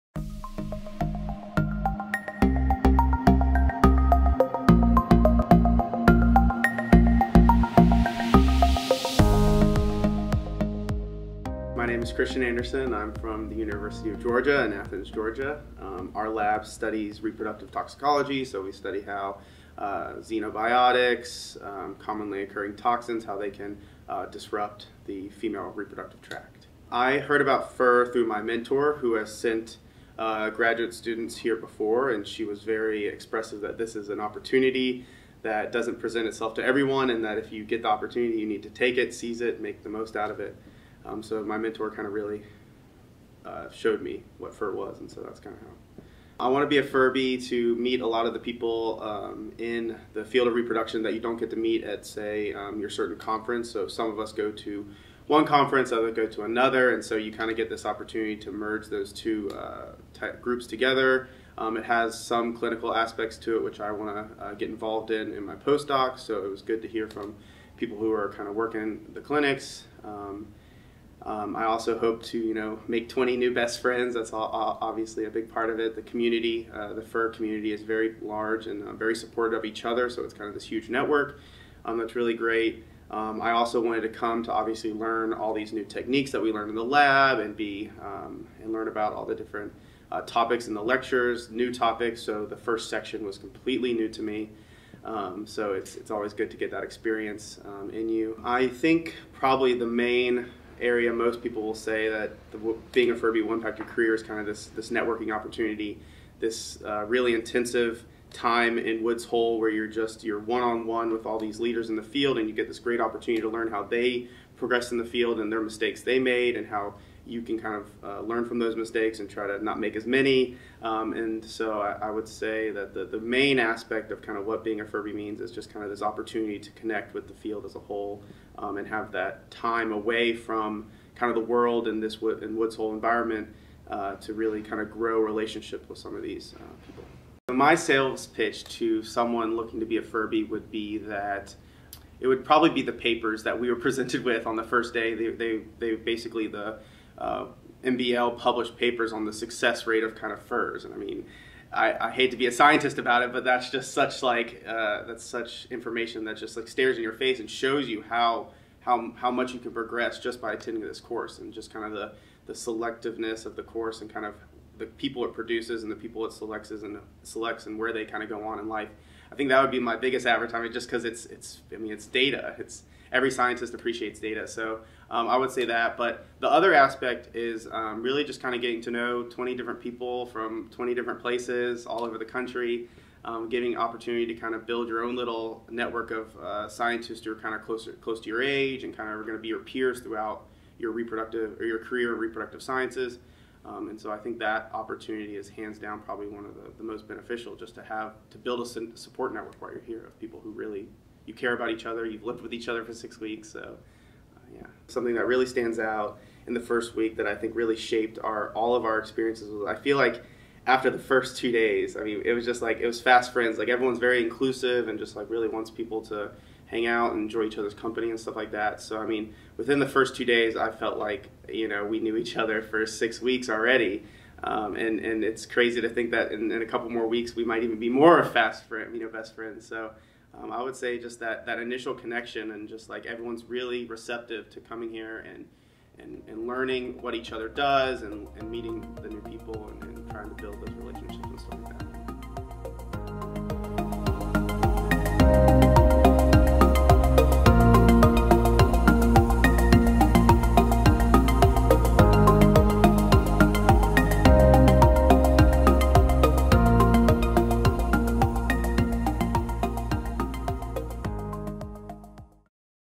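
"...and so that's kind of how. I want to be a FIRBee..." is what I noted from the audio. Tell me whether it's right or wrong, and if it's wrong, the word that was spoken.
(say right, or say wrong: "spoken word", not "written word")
right.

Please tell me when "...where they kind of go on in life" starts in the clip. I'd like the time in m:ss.
2:47.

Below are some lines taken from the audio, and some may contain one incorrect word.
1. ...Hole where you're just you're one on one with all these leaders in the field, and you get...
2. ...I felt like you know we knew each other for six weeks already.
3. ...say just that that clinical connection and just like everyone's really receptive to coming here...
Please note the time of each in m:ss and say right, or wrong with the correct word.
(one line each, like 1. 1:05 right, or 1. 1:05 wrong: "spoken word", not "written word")
1. 1:49 right
2. 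3:40 right
3. 3:50 wrong: "initial", not "clinical".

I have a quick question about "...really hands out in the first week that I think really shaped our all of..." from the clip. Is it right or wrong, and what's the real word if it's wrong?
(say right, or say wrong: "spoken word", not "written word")
wrong: "stands", not "hands".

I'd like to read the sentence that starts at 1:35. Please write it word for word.
Um, so it's, it's always good to get that experience um, in you.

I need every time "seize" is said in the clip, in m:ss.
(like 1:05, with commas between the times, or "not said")
0:39.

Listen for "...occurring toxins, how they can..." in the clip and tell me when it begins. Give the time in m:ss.
0:22.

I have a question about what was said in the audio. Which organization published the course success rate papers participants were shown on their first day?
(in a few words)
MBL.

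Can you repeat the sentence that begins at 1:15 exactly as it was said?
The community, uh, the FIR community, is very large and uh, very supportive of each other.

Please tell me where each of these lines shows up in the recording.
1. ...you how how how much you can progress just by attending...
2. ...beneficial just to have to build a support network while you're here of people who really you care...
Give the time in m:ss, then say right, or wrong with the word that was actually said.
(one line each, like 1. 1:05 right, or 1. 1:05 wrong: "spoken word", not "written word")
1. 2:37 right
2. 3:17 right.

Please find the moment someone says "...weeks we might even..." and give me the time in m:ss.
3:47.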